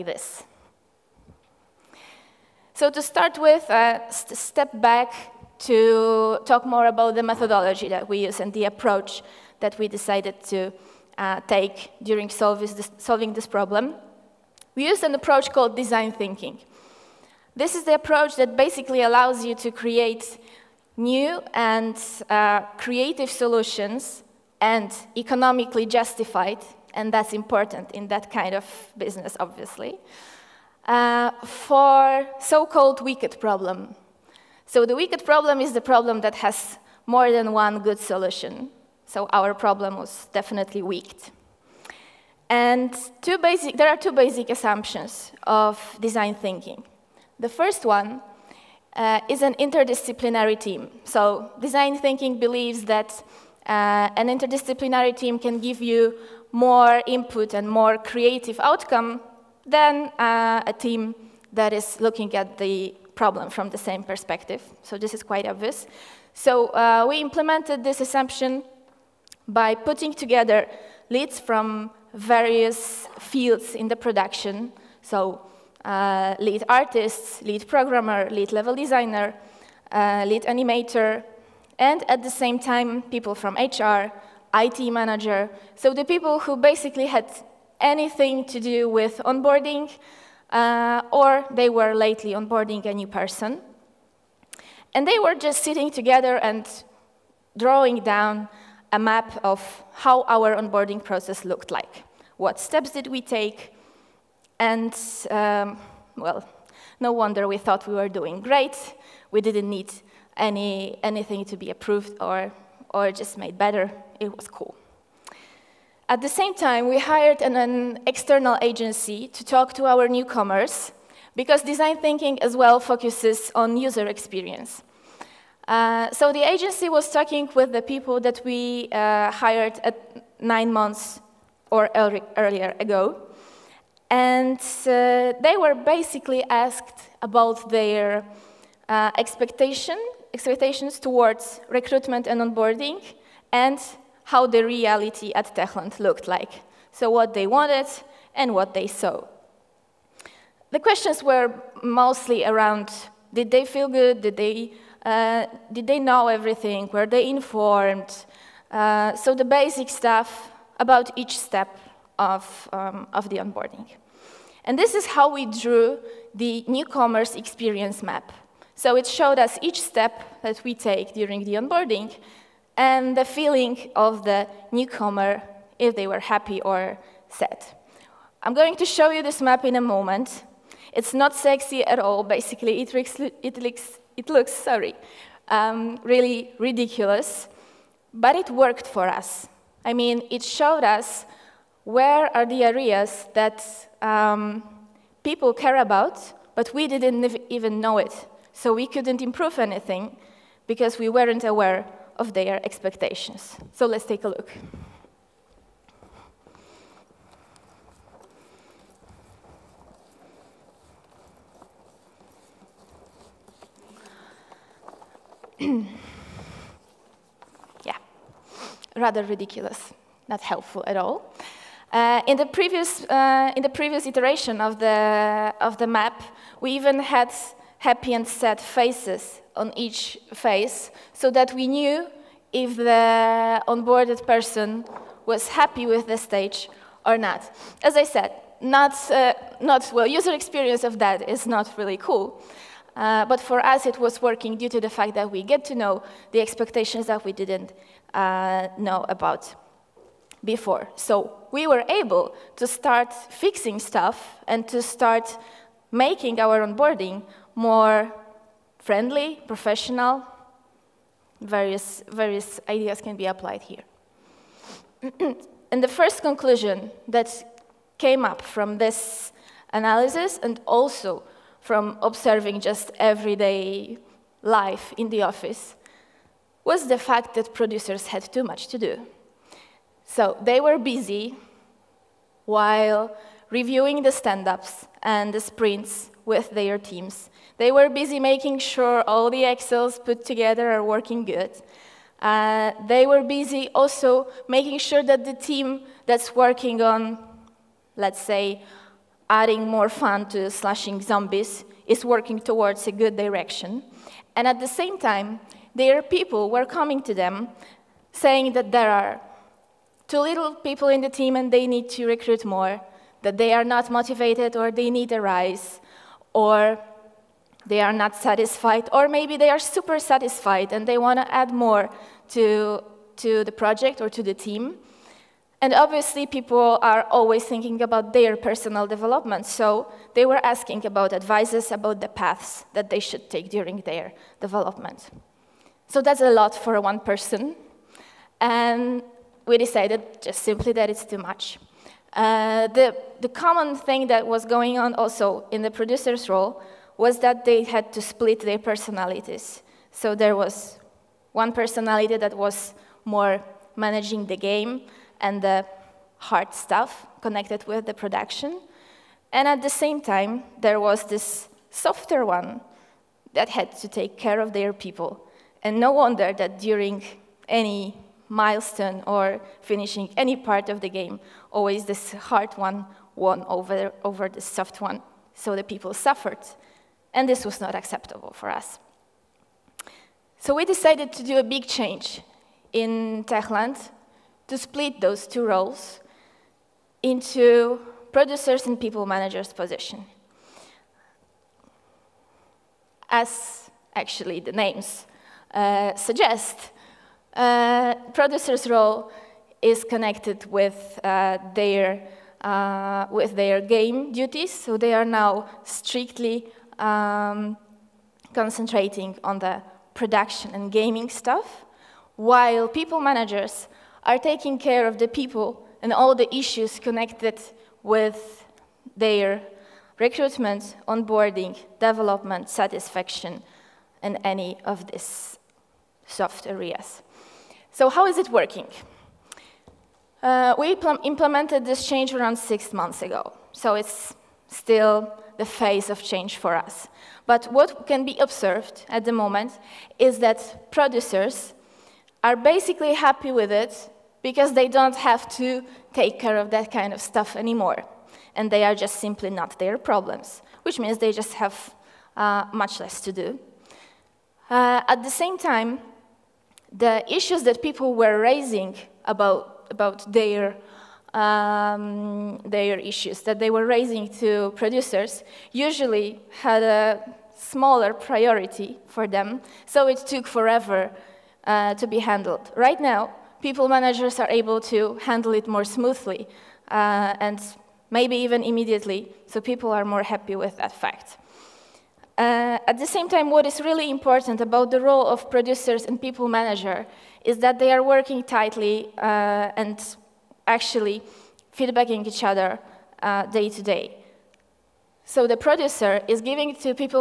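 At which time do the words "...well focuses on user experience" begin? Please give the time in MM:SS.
02:02.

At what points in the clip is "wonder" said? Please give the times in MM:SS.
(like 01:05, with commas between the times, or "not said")
01:47, 06:05.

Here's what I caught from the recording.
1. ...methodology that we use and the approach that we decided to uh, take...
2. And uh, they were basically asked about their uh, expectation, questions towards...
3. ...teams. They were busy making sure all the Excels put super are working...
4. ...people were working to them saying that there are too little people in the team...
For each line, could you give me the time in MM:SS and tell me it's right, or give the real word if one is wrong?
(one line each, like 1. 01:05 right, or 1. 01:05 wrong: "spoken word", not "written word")
1. 00:07 right
2. 02:14 wrong: "expectations", not "questions"
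3. 04:46 wrong: "together", not "super"
4. 05:06 wrong: "coming", not "working".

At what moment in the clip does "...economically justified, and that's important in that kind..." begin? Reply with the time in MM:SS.
00:25.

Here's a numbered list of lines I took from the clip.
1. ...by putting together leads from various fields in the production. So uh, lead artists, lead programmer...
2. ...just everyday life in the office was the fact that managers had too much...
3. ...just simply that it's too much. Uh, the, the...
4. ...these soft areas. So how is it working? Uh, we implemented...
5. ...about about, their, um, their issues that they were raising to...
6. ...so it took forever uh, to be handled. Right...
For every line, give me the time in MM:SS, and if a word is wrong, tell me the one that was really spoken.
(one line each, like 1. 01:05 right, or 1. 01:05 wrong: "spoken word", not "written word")
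1. 01:09 right
2. 04:32 wrong: "producers", not "managers"
3. 05:40 right
4. 07:04 right
5. 07:39 right
6. 07:49 right.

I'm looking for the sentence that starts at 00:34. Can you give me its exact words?
So the wicked problem is the problem that has more than one good solution.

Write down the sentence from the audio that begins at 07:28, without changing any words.
And they are just simply not their problems, which means they just have uh, much less to do.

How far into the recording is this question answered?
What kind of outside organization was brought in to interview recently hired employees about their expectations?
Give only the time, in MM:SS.
01:58.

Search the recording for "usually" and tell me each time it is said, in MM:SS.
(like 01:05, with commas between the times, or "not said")
07:45.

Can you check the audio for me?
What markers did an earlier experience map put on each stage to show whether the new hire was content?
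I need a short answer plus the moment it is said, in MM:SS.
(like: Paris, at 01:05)
Happy and sad faces, at 03:47.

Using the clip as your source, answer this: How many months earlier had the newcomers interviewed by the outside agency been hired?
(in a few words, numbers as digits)
9.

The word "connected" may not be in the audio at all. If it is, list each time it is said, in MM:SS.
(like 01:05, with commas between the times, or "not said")
05:57, 06:39, 06:56.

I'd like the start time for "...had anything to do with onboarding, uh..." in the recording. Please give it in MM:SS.
01:27.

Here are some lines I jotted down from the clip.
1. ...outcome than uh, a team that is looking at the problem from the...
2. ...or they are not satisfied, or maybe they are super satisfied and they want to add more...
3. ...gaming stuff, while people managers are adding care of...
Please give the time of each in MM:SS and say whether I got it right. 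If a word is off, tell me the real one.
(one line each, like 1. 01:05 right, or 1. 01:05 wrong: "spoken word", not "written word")
1. 00:58 right
2. 05:16 right
3. 06:50 wrong: "taking", not "adding".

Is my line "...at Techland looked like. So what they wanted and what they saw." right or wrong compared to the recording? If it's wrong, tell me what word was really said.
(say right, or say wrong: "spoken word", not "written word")
right.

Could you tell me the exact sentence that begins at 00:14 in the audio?
We used an approach called design thinking.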